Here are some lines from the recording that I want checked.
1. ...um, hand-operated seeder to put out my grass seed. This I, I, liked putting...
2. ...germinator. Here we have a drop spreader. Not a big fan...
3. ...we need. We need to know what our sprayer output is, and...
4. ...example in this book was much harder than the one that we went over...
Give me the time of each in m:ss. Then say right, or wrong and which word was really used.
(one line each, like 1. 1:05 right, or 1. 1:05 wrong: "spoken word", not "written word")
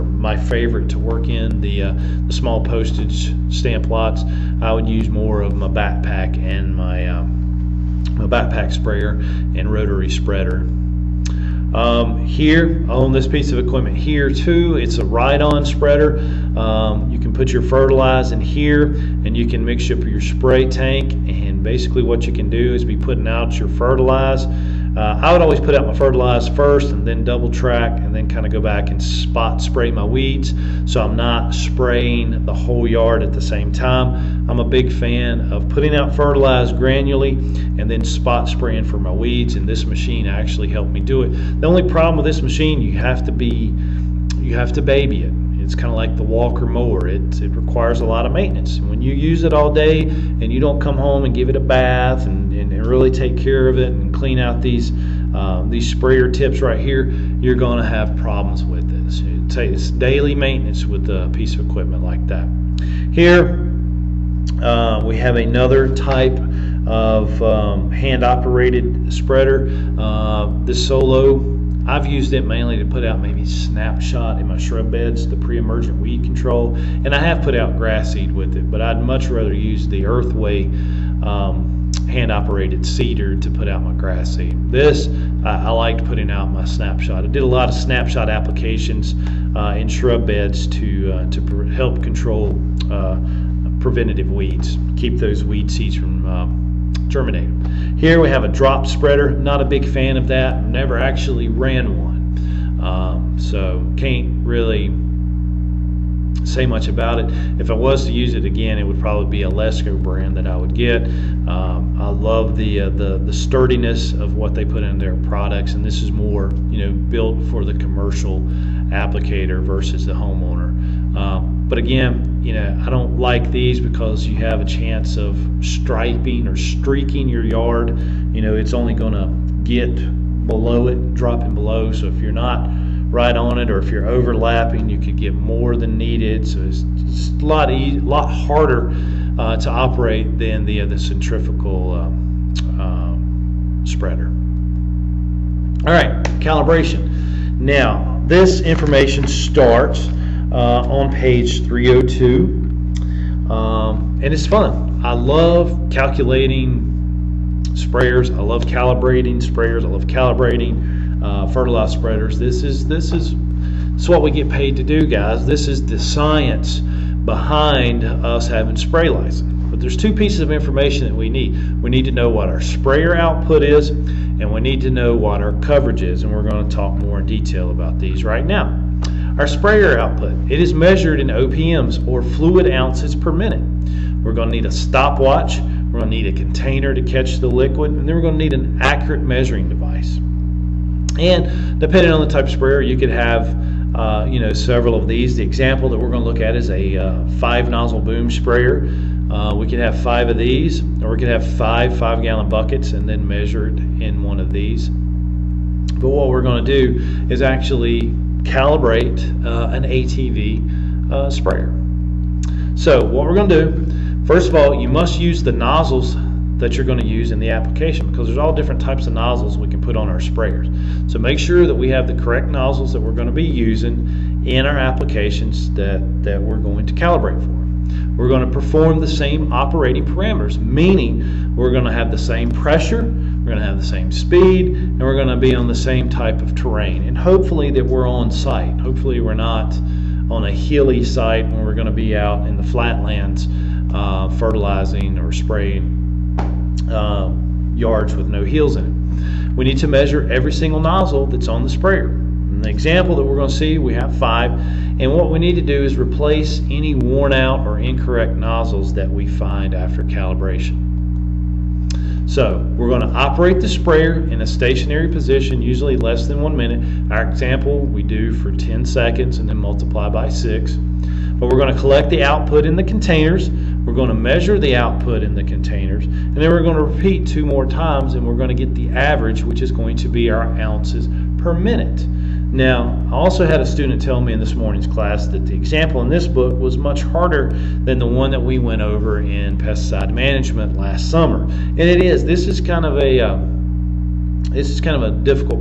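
1. 1:21 right
2. 1:37 right
3. 2:51 right
4. 4:45 right.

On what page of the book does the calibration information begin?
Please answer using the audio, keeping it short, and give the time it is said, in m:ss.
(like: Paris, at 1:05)
302, at 2:31.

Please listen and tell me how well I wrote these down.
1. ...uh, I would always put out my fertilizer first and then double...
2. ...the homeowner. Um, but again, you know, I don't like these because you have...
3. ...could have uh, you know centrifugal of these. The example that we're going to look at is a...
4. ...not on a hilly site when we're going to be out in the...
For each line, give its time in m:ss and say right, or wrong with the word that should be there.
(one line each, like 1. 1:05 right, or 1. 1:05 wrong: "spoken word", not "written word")
1. 0:24 right
2. 2:00 right
3. 3:12 wrong: "several", not "centrifugal"
4. 3:59 right.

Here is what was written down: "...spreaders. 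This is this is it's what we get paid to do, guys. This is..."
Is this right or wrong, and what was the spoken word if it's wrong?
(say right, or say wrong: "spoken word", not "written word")
right.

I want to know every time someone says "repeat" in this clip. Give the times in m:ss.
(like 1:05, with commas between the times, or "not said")
4:36.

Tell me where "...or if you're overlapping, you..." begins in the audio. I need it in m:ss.
2:13.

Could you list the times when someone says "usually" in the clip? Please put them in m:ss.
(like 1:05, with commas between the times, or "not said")
4:25.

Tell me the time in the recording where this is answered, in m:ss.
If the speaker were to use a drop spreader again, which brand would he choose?
1:49.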